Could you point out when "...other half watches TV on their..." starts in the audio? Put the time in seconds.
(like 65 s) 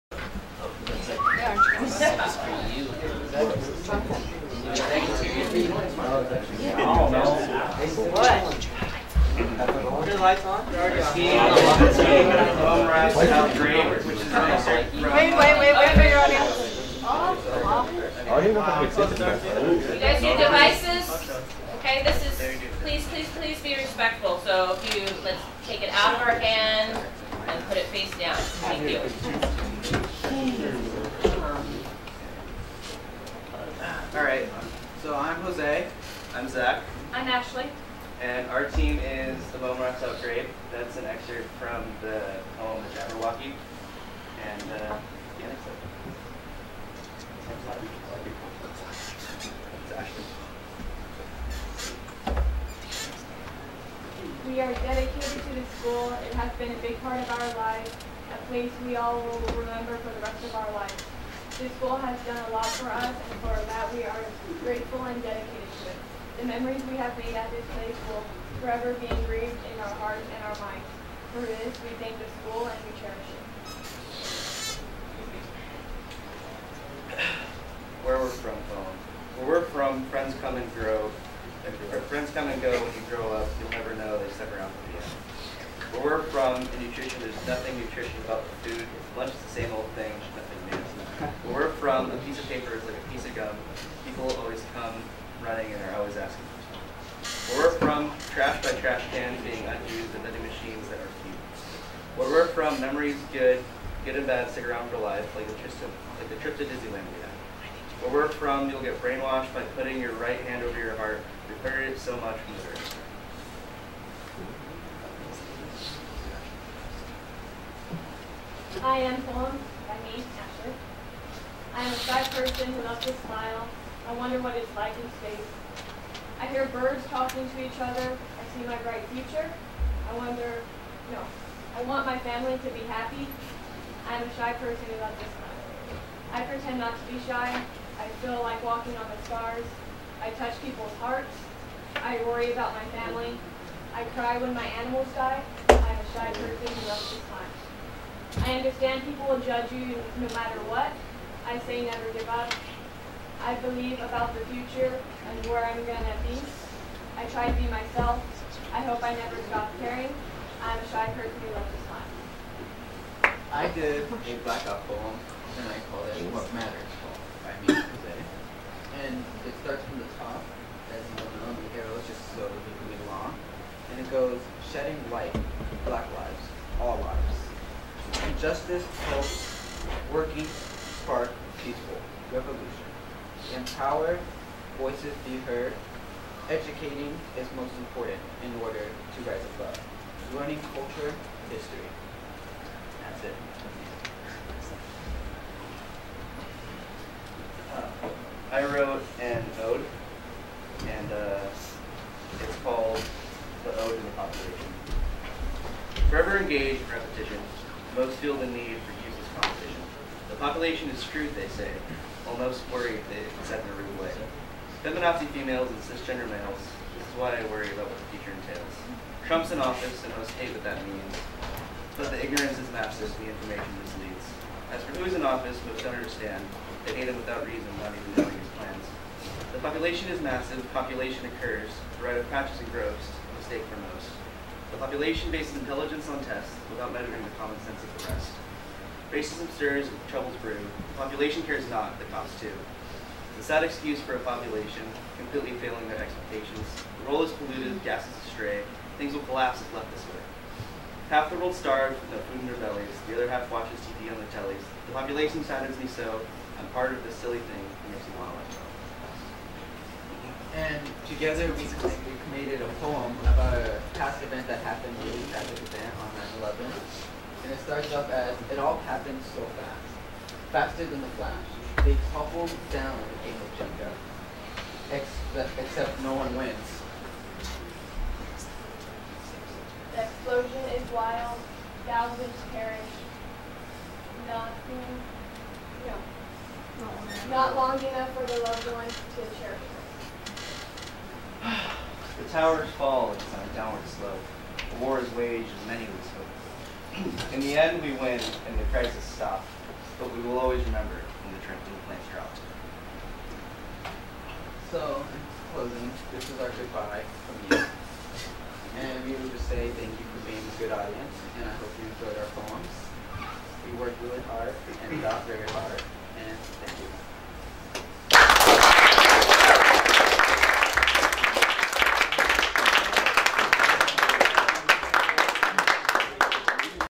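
253 s.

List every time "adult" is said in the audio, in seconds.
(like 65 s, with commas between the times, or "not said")
not said.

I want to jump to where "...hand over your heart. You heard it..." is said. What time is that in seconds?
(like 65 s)
110 s.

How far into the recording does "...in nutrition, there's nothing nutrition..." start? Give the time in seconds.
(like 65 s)
86 s.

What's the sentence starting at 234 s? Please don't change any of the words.
The population bases intelligence on tests without measuring the common sense of the rest.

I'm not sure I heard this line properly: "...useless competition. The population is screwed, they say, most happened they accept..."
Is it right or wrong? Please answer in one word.
wrong.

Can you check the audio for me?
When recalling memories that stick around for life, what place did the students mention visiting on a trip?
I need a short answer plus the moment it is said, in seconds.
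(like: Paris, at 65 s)
Disneyland, at 106 s.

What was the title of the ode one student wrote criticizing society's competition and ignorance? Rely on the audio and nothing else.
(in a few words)
The Ode to the Population.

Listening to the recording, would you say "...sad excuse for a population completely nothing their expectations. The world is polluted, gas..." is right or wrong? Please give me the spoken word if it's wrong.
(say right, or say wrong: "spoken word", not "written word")
wrong: "failing", not "nothing".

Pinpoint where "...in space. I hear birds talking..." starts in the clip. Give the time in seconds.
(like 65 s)
124 s.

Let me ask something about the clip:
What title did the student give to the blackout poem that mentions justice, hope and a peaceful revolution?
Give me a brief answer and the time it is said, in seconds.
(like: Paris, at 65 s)
What Matters, at 166 s.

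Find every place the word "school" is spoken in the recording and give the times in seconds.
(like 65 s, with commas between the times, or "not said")
55 s, 61 s, 72 s.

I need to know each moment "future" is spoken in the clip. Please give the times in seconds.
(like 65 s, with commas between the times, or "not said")
129 s, 154 s, 218 s.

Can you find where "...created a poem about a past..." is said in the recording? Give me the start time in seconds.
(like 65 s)
262 s.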